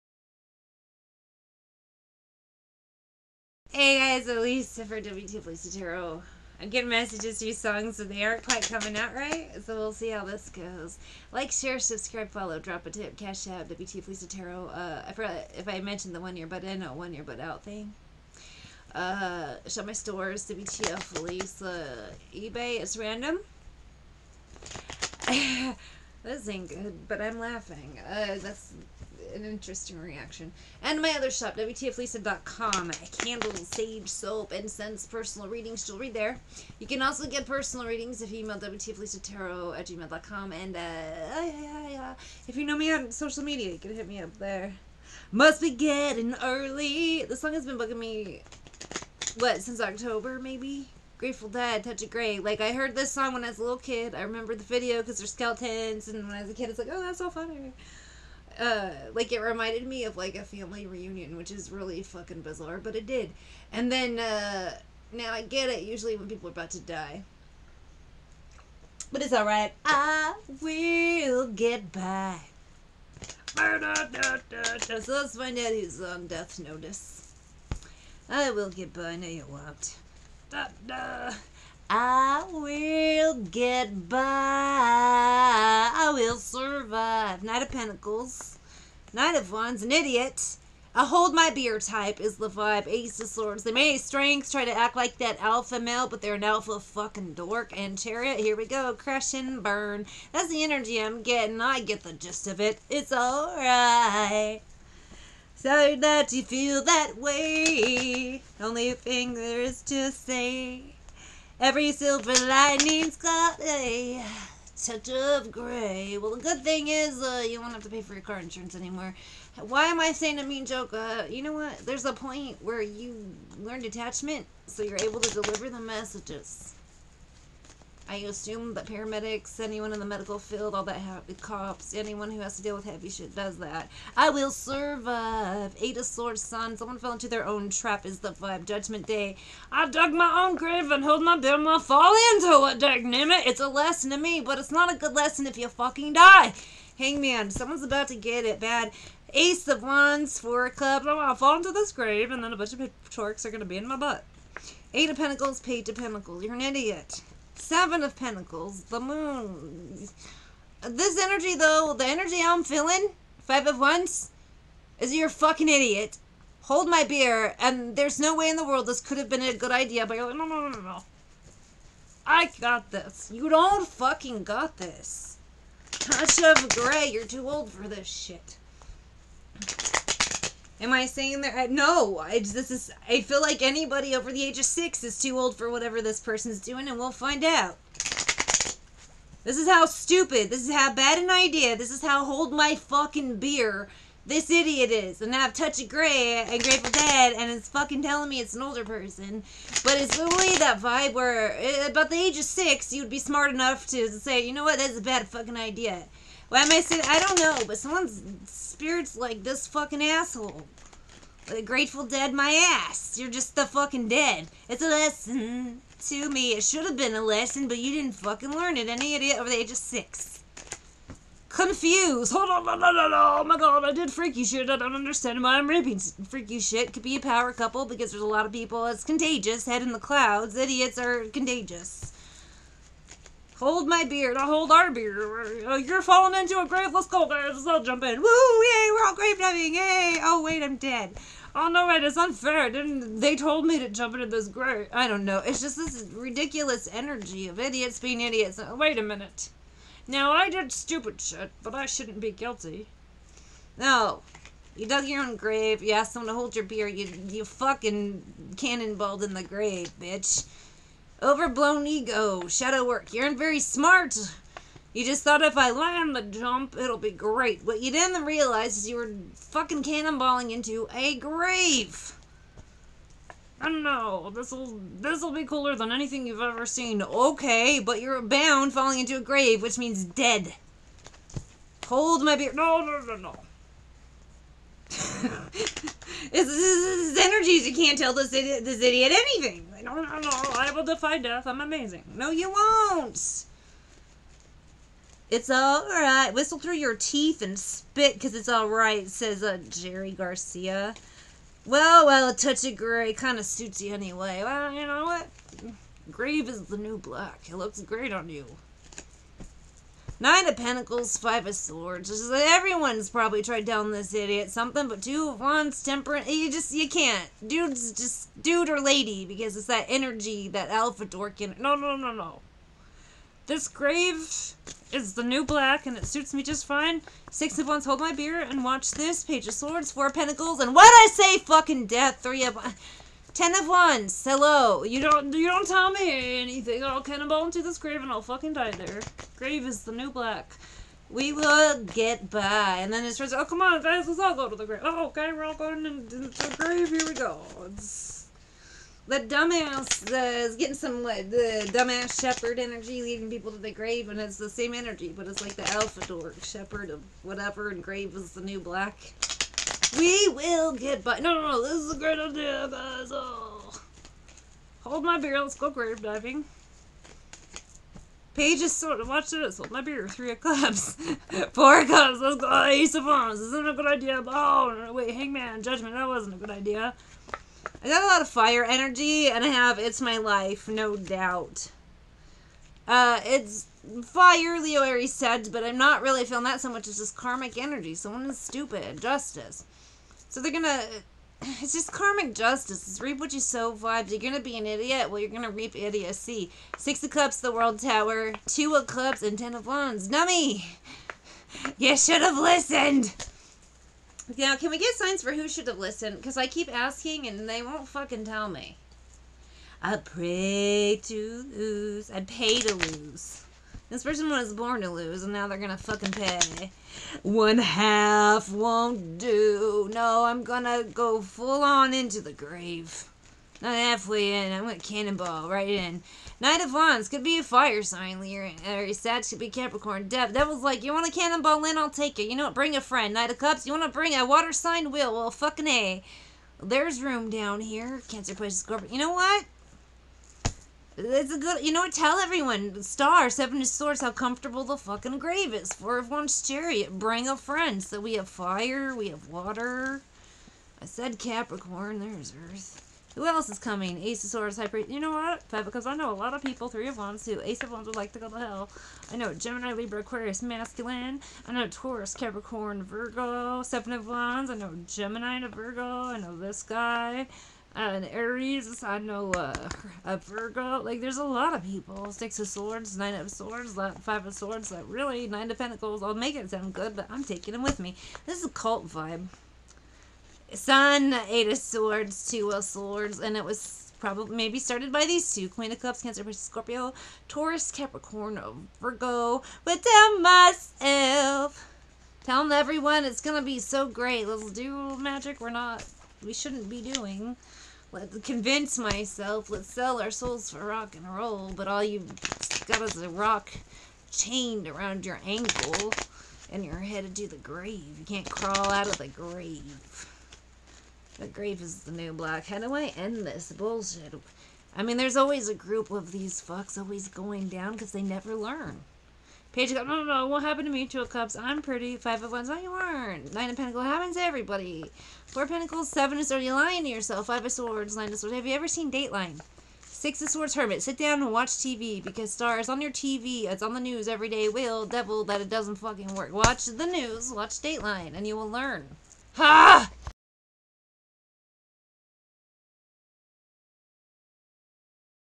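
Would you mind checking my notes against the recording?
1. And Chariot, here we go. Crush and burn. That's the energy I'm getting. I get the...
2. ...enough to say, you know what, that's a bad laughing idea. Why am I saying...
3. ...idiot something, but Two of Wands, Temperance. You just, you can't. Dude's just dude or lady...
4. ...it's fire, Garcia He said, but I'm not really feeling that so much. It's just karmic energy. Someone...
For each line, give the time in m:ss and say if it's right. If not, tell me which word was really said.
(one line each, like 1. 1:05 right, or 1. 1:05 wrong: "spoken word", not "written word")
1. 1:37 right
2. 3:23 wrong: "fucking", not "laughing"
3. 5:14 right
4. 6:23 wrong: "Leo", not "Garcia".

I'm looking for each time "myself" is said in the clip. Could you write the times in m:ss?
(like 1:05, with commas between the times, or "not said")
8:10, 8:18.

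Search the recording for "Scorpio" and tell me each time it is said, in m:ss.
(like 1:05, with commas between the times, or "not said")
7:18, 8:06.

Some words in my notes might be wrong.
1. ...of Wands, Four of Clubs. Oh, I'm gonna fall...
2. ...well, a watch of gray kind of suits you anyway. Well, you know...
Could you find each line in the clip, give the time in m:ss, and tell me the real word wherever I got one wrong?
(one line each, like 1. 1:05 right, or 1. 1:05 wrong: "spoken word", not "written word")
1. 2:29 right
2. 5:02 wrong: "touch", not "watch".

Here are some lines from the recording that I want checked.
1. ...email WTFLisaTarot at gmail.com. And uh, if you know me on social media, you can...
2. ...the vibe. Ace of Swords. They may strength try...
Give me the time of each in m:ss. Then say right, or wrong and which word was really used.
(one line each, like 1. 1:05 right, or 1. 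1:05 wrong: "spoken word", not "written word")
1. 0:38 right
2. 1:32 right.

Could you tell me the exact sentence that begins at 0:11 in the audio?
Like, share, subscribe, follow, drop a tip, Cash App, WTF Lisa Tarot.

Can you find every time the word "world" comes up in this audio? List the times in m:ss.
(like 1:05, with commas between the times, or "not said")
2:48, 6:37.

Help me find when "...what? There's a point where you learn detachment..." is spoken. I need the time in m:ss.
2:01.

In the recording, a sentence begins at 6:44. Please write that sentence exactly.
Now, can we get signs for who should have listened?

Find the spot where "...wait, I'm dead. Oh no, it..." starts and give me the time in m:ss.
4:00.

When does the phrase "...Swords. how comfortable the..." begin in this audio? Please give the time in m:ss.
7:23.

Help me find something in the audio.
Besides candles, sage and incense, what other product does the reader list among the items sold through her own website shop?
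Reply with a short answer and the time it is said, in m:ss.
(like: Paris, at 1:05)
Soap, at 0:34.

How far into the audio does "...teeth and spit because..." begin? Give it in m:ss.
4:56.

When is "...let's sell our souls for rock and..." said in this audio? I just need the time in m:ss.
8:19.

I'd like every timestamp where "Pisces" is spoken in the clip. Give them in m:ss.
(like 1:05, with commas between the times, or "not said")
7:18, 8:06.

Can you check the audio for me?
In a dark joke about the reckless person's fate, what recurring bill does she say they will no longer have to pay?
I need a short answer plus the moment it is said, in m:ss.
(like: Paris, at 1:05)
Car insurance, at 1:58.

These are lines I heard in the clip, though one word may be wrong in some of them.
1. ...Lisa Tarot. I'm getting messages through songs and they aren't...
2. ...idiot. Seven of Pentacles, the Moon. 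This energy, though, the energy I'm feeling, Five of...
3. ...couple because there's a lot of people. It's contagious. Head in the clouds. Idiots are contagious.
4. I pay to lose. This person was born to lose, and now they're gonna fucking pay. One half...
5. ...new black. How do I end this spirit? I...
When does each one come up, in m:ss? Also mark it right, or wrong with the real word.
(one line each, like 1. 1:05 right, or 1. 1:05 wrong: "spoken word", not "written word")
1. 0:05 right
2. 2:36 right
3. 3:47 right
4. 6:52 right
5. 8:31 wrong: "bullshit", not "spirit".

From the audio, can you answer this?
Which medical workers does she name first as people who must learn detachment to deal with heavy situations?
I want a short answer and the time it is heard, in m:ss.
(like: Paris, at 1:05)
Paramedics, at 2:08.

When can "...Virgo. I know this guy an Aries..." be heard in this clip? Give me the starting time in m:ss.
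7:45.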